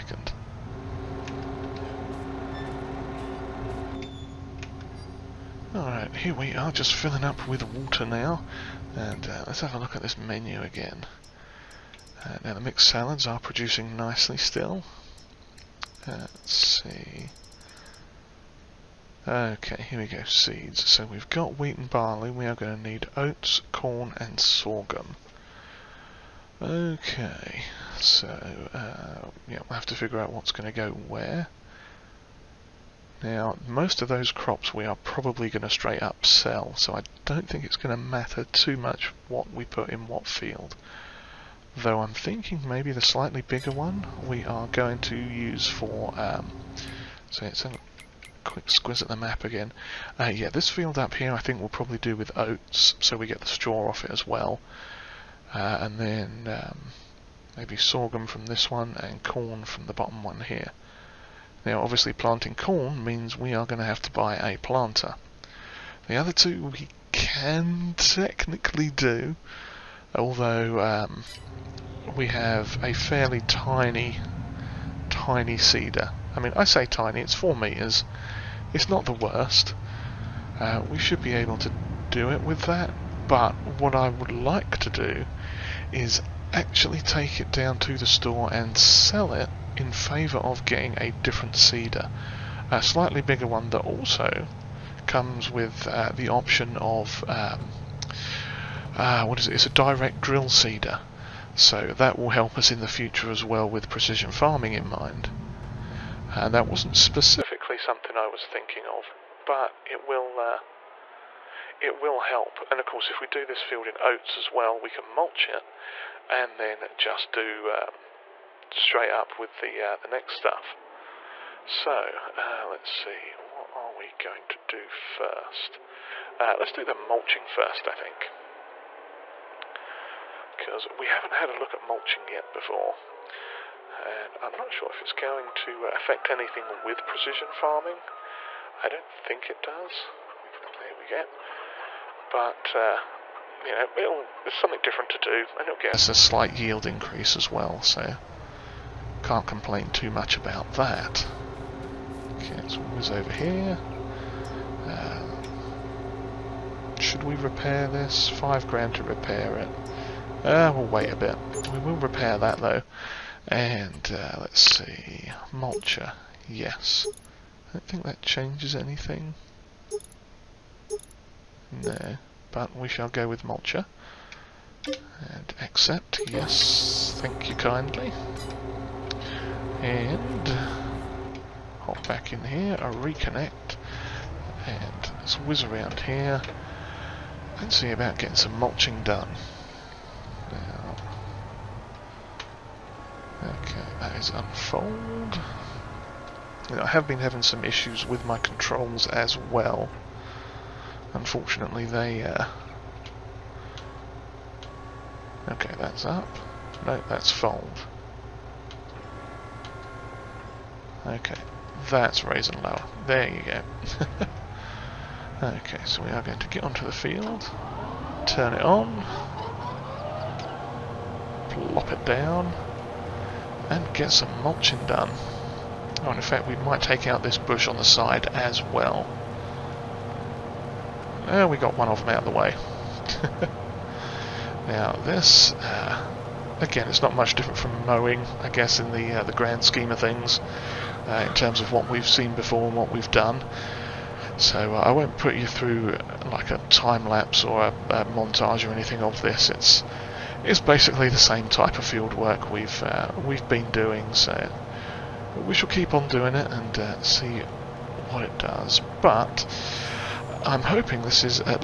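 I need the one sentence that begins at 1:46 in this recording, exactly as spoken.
Uh, that wasn't specifically something I was thinking of, but it will uh, it will help.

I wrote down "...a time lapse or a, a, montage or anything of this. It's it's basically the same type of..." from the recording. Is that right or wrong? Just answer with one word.
right.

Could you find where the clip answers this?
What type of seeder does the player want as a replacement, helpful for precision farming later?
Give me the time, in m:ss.
1:39.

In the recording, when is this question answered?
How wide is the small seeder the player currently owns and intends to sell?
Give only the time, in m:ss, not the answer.
1:17.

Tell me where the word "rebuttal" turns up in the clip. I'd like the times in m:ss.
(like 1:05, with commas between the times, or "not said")
not said.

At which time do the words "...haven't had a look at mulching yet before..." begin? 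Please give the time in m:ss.
2:11.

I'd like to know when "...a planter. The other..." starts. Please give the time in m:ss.
1:04.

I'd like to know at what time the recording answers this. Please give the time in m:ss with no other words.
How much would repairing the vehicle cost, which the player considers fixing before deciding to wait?
2:38.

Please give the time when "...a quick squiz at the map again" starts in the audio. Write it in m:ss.
0:47.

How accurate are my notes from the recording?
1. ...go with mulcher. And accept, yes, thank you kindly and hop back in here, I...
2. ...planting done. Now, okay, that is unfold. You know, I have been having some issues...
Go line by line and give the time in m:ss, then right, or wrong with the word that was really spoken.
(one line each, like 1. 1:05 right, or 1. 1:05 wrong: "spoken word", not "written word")
1. 2:53 right
2. 3:08 wrong: "mulching", not "planting".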